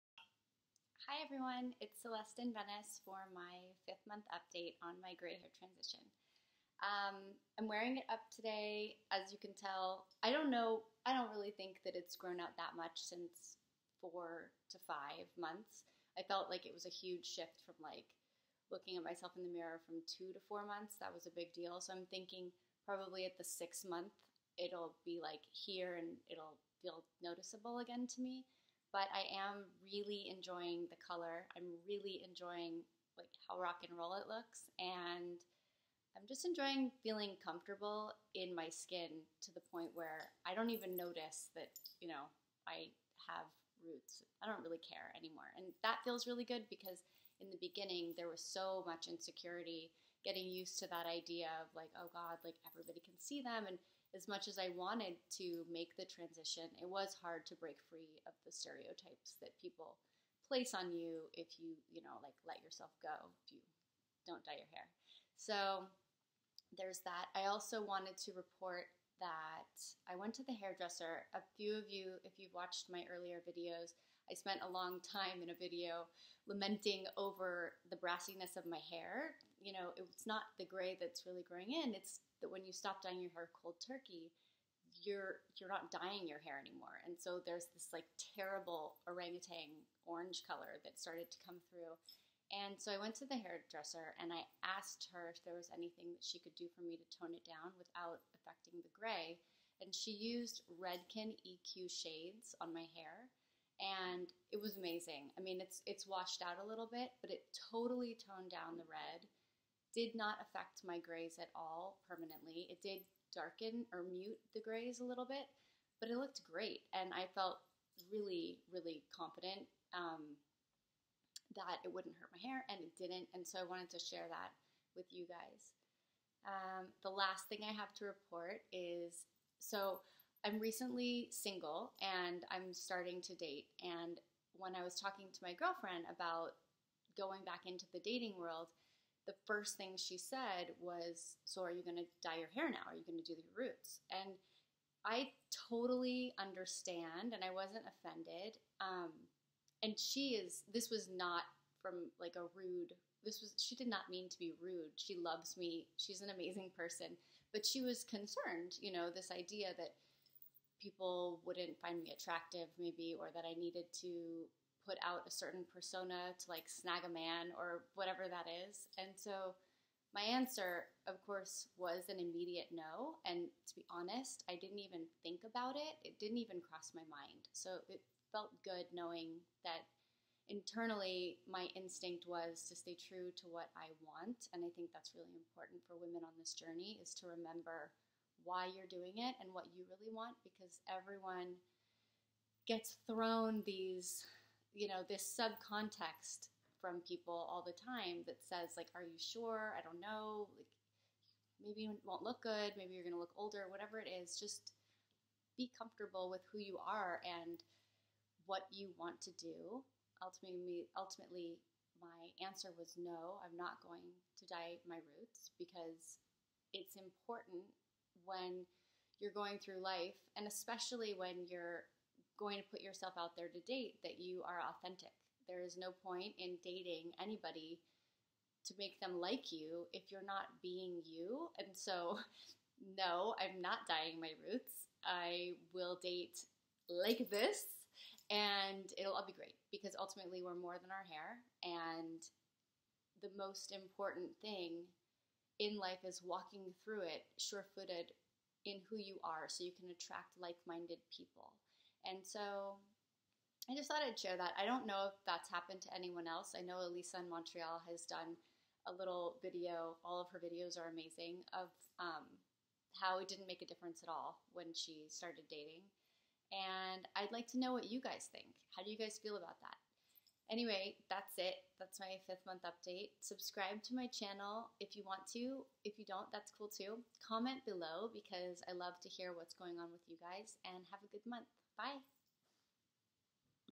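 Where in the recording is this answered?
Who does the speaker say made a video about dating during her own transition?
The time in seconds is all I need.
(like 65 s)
256 s.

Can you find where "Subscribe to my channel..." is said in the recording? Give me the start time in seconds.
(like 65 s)
273 s.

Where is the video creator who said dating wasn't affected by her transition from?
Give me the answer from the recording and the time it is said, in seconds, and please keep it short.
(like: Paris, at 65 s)
Montreal, at 257 s.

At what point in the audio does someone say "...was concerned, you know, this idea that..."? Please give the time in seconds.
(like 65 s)
157 s.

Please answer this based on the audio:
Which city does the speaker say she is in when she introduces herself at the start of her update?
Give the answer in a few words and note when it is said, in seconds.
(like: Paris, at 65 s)
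Venice, at 2 s.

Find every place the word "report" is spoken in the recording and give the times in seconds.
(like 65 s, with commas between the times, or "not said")
68 s, 128 s.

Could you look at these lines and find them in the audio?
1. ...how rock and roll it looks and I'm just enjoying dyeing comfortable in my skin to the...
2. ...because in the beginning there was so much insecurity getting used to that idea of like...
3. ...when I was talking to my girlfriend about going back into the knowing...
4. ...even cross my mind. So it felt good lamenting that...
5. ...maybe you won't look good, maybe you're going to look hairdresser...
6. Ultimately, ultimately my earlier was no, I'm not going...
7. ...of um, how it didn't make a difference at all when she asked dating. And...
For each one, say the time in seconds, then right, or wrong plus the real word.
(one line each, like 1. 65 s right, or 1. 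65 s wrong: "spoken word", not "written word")
1. 33 s wrong: "feeling", not "dyeing"
2. 46 s right
3. 134 s wrong: "dating", not "knowing"
4. 176 s wrong: "knowing", not "lamenting"
5. 201 s wrong: "older", not "hairdresser"
6. 210 s wrong: "answer", not "earlier"
7. 261 s wrong: "started", not "asked".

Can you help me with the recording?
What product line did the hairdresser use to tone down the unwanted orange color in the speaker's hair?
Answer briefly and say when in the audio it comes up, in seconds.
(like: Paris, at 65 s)
Redken EQ shades, at 100 s.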